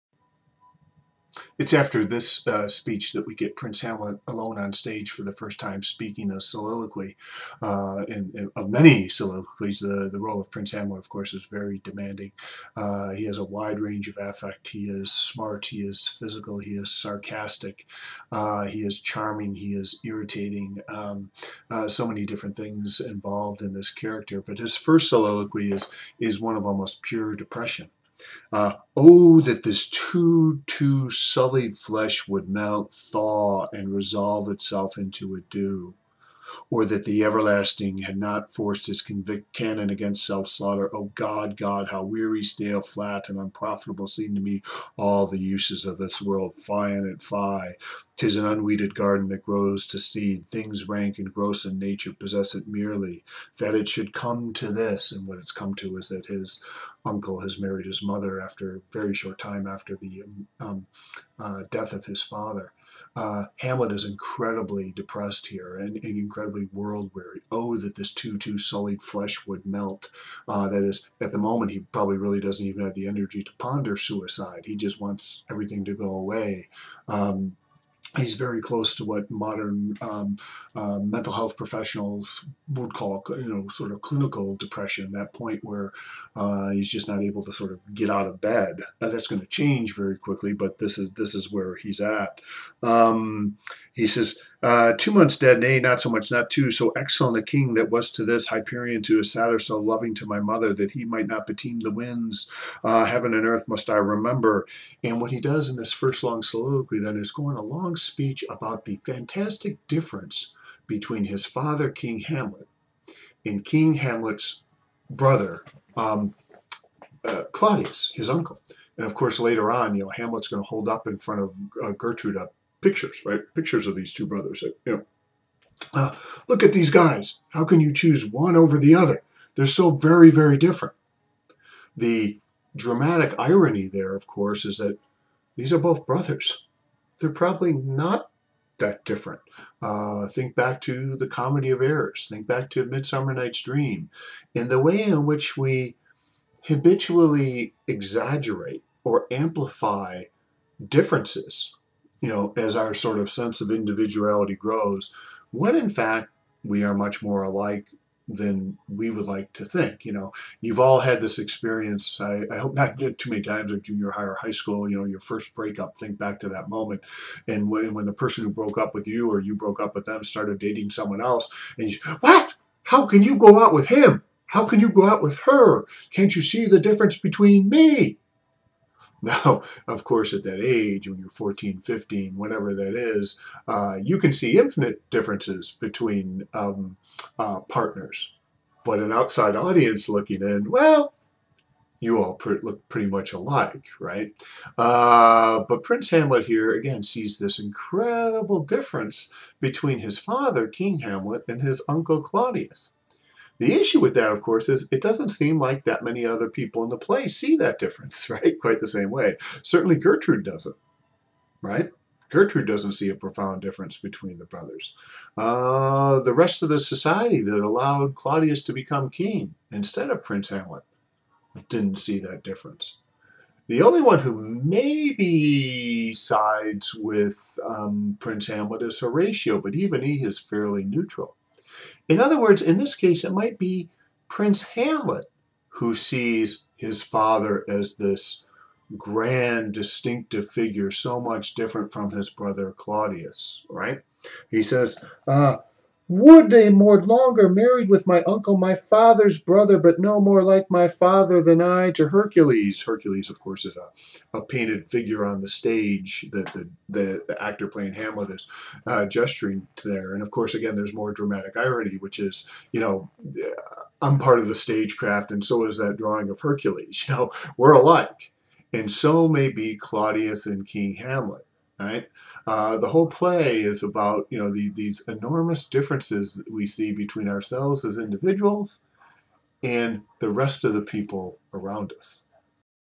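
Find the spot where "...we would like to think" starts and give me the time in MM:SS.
02:38.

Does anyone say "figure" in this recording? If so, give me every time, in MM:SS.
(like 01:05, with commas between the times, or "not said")
04:00, 04:14.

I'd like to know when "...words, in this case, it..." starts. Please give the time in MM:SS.
03:52.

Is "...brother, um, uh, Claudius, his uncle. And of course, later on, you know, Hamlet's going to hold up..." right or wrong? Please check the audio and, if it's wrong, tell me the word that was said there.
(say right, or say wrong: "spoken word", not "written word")
right.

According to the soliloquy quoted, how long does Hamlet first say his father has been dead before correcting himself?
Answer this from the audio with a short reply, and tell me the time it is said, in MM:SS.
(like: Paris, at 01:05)
2 months, at 01:34.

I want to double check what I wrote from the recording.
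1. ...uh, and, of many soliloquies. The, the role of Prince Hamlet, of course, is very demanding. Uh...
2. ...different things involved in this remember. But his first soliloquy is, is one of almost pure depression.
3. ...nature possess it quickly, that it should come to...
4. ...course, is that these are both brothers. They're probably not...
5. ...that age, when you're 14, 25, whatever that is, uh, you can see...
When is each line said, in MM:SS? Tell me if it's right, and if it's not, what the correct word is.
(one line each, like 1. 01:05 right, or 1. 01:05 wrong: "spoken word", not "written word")
1. 00:07 right
2. 00:22 wrong: "character", not "remember"
3. 00:51 wrong: "merely", not "quickly"
4. 02:14 right
5. 03:00 wrong: "15", not "25".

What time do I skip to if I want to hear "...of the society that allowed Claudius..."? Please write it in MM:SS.
03:36.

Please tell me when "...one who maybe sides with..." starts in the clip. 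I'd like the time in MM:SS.
03:44.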